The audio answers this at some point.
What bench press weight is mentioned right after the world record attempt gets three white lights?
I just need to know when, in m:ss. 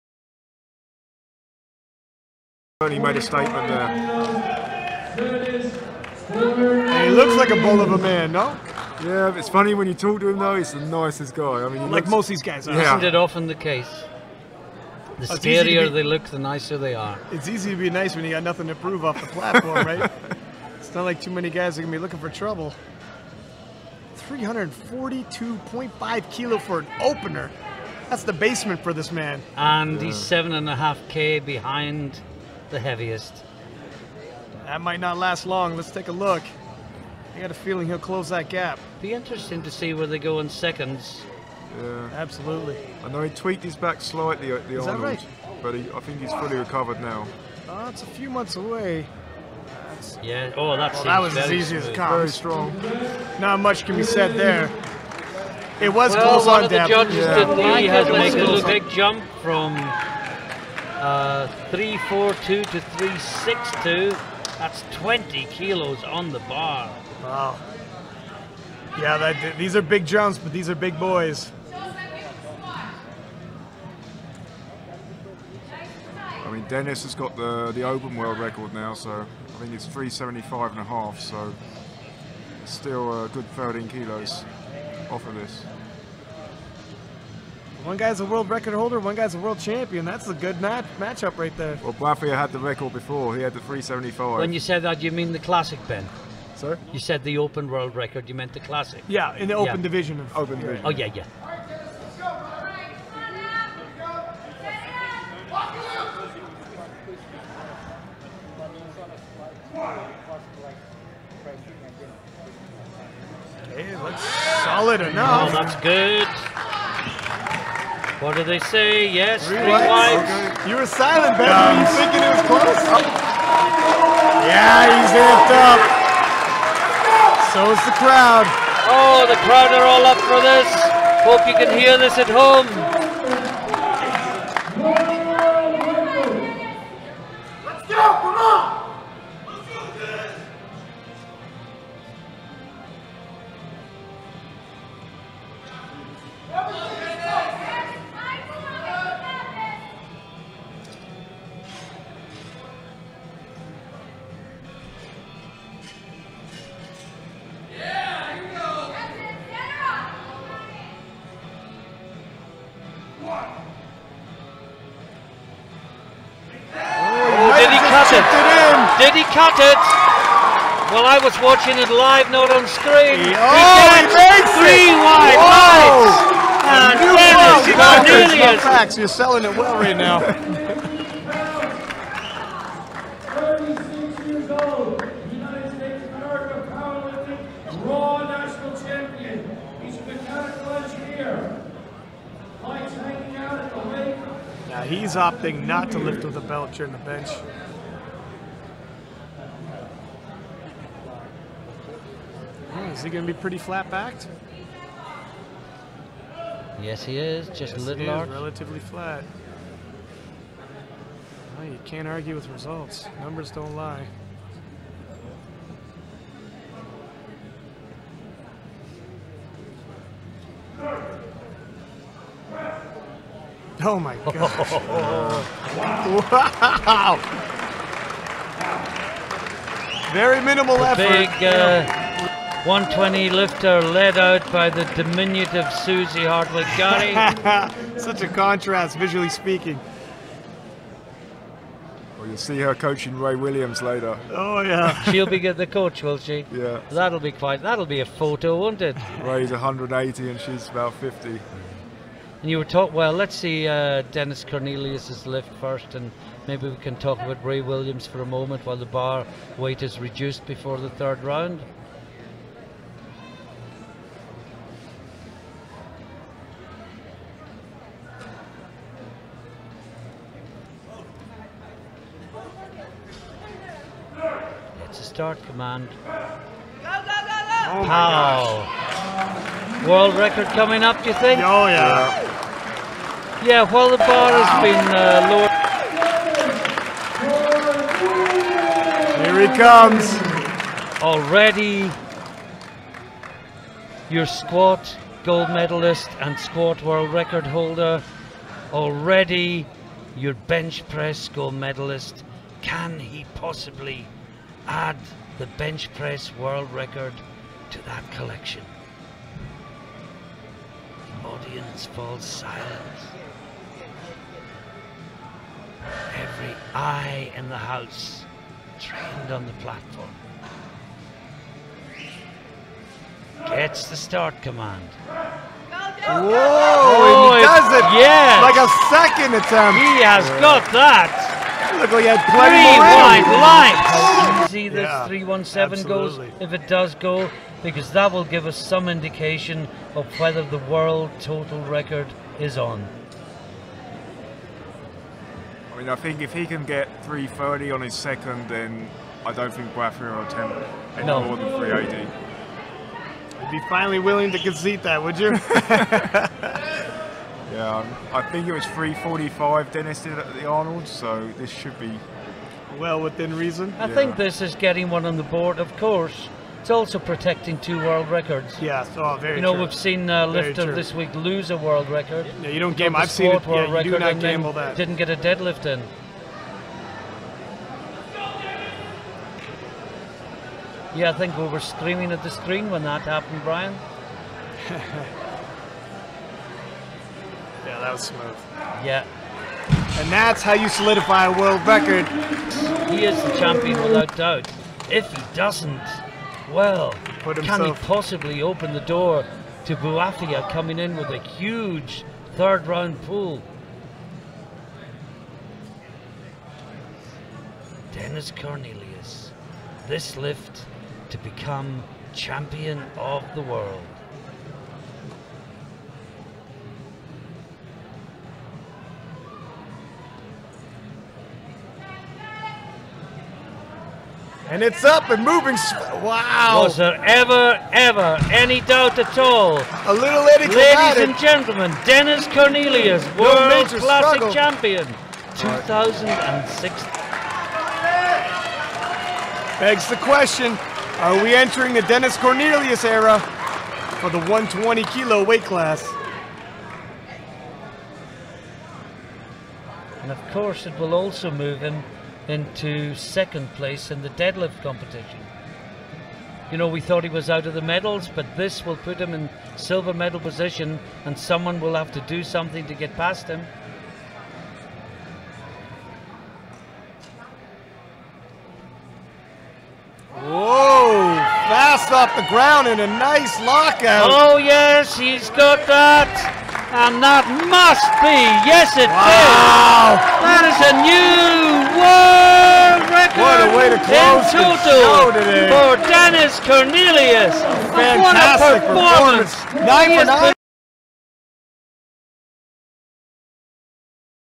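5:35.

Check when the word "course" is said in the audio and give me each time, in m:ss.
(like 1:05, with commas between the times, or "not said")
6:05, 7:30.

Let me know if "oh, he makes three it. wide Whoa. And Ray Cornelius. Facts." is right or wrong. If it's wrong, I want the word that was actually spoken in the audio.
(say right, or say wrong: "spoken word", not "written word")
wrong: "Dennis", not "Ray".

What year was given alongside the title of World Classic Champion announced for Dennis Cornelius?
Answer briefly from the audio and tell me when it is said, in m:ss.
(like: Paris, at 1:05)
2006, at 7:15.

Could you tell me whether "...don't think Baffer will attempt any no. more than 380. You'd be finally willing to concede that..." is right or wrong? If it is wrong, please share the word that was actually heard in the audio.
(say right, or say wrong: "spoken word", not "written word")
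right.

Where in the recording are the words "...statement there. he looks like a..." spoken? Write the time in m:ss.
0:03.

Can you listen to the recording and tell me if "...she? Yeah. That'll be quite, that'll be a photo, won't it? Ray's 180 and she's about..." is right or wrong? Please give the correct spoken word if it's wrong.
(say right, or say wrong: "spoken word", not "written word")
right.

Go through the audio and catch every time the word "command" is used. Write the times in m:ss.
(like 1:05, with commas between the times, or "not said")
4:35, 5:24.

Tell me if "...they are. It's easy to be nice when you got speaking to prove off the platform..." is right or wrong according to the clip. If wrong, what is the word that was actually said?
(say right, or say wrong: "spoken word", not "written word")
wrong: "nothing", not "speaking".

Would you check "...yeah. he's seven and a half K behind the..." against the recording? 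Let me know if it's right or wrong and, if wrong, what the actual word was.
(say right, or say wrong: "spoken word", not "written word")
right.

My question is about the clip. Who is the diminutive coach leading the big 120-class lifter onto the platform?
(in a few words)
Susie Hartwig.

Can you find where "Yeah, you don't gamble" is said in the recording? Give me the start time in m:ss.
6:12.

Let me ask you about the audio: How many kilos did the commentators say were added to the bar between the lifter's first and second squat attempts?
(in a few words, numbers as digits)
20 kilos.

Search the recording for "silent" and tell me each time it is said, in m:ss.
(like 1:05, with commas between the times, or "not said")
2:00, 5:12.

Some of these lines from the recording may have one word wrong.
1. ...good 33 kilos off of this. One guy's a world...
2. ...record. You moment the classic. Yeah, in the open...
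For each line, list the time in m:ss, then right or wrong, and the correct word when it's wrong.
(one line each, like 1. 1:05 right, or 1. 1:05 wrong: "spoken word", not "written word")
1. 1:23 wrong: "13", not "33"
2. 1:37 wrong: "meant", not "moment".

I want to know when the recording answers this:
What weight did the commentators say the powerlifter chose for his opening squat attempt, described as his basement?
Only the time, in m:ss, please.
0:24.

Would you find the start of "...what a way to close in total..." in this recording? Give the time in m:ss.
8:03.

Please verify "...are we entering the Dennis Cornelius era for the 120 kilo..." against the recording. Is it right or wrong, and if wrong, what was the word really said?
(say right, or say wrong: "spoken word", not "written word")
right.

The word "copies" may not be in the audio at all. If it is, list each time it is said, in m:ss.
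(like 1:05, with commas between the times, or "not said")
not said.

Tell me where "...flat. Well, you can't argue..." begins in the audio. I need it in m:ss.
3:28.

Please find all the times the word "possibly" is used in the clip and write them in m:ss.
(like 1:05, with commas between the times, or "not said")
5:03, 6:37.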